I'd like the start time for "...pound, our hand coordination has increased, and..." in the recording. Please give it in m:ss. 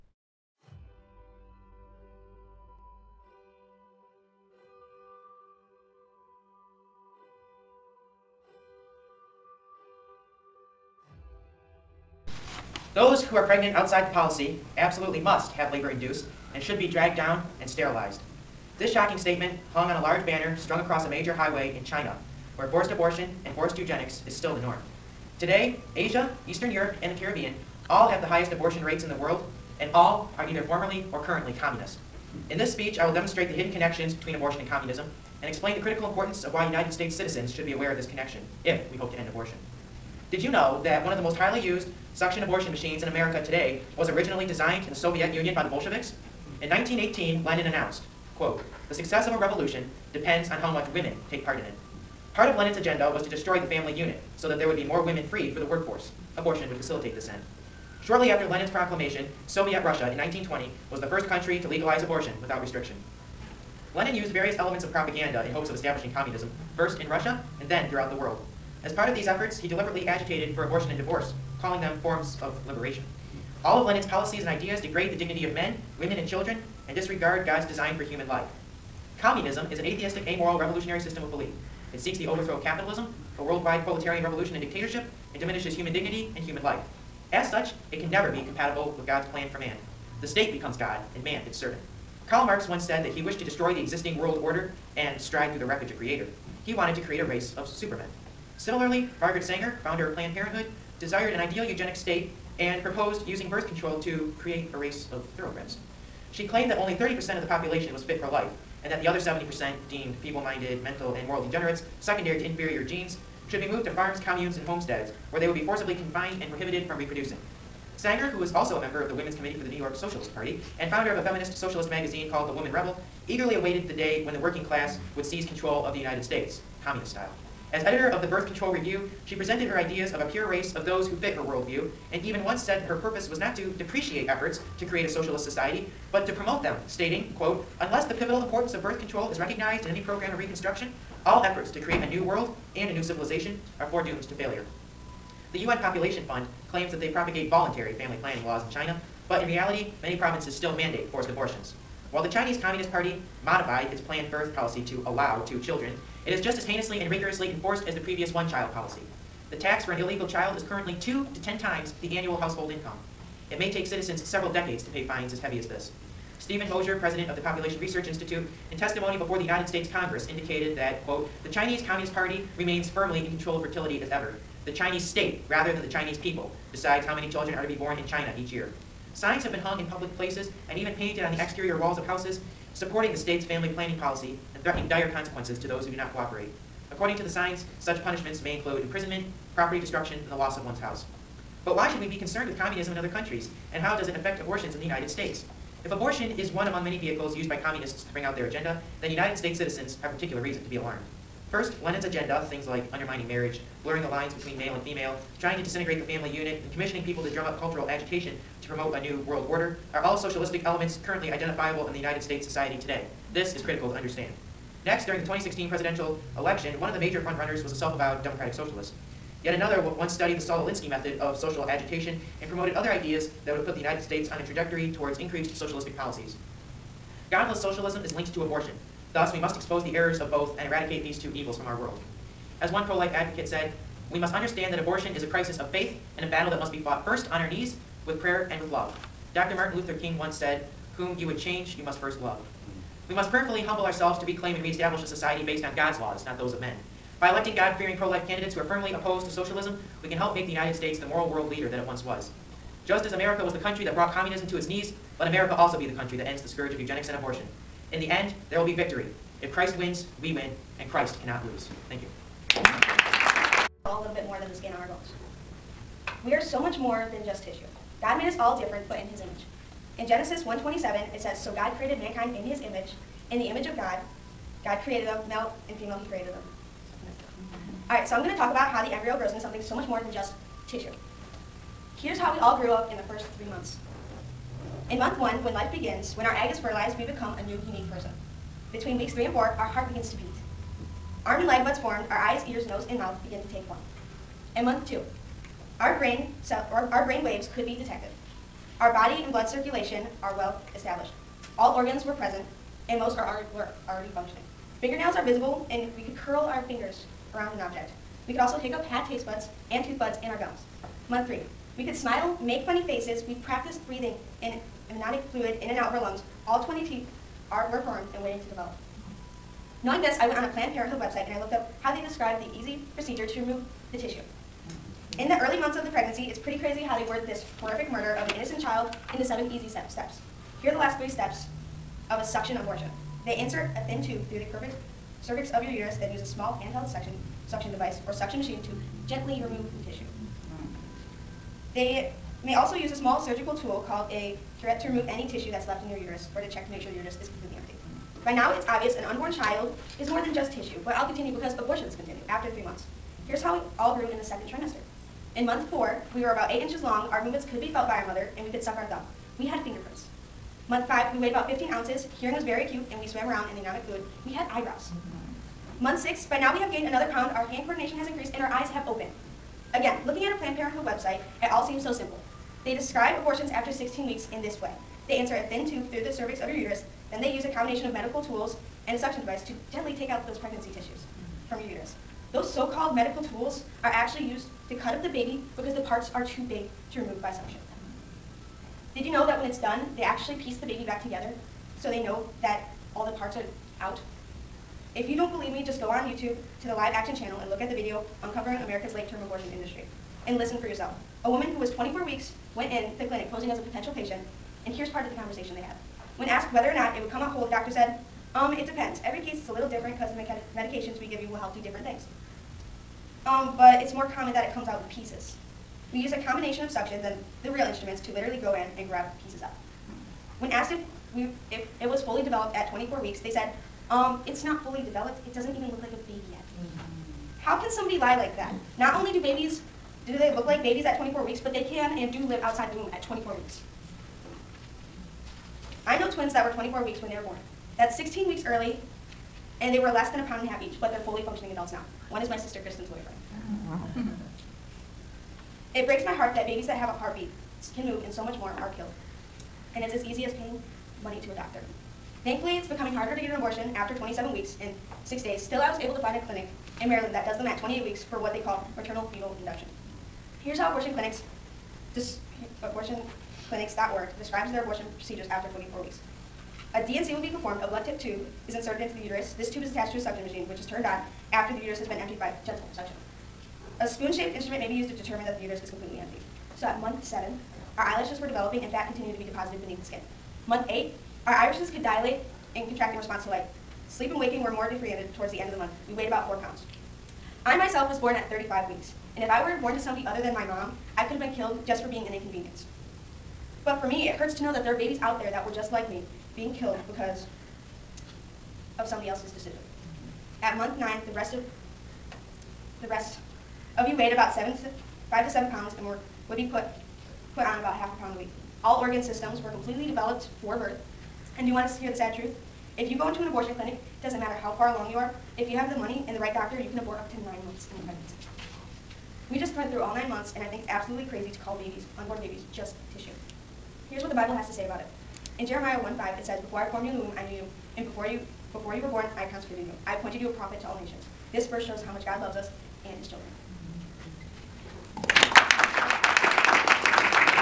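6:07.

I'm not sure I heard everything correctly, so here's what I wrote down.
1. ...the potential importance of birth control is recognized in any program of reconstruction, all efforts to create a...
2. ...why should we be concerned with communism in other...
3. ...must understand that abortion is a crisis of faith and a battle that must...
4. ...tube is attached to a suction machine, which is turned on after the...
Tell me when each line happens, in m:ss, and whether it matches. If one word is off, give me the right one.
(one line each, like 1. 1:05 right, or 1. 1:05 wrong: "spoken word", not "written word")
1. 2:18 wrong: "pivotal", not "potential"
2. 3:11 right
3. 3:54 right
4. 7:49 right.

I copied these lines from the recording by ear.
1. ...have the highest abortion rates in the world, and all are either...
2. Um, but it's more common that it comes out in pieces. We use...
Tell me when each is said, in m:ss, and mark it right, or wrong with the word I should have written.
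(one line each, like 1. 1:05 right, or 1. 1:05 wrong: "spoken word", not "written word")
1. 0:28 right
2. 6:53 right.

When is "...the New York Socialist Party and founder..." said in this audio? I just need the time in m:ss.
1:59.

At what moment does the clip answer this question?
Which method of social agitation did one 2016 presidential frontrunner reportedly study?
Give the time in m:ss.
3:40.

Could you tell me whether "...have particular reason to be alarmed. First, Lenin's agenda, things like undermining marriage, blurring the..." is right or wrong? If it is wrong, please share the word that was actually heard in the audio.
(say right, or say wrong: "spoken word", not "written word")
right.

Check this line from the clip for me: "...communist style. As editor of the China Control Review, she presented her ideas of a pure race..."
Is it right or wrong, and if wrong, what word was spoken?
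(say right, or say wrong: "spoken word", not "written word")
wrong: "Birth", not "China".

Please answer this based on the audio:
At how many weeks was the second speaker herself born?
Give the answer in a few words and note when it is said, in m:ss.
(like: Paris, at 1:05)
35 weeks, at 8:08.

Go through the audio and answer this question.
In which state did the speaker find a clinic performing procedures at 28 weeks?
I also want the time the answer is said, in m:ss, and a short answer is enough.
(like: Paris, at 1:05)
Maryland, at 7:36.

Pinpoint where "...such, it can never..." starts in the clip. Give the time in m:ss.
1:27.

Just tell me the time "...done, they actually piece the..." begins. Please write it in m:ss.
6:29.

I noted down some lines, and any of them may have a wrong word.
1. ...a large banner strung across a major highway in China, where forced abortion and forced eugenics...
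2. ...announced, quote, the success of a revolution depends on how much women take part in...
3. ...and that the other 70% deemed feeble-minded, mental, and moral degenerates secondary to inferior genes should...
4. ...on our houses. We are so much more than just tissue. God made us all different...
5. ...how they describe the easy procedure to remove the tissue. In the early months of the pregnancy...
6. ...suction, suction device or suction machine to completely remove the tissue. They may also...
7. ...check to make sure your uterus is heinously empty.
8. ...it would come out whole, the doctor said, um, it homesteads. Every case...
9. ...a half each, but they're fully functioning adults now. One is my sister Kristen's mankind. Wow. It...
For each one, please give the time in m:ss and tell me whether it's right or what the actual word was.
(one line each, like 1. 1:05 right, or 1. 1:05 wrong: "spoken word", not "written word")
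1. 0:20 right
2. 0:47 right
3. 1:48 right
4. 4:24 wrong: "bones", not "houses"
5. 5:21 right
6. 5:36 wrong: "gently", not "completely"
7. 5:46 wrong: "completely", not "heinously"
8. 6:46 wrong: "depends", not "homesteads"
9. 7:20 wrong: "boyfriend", not "mankind".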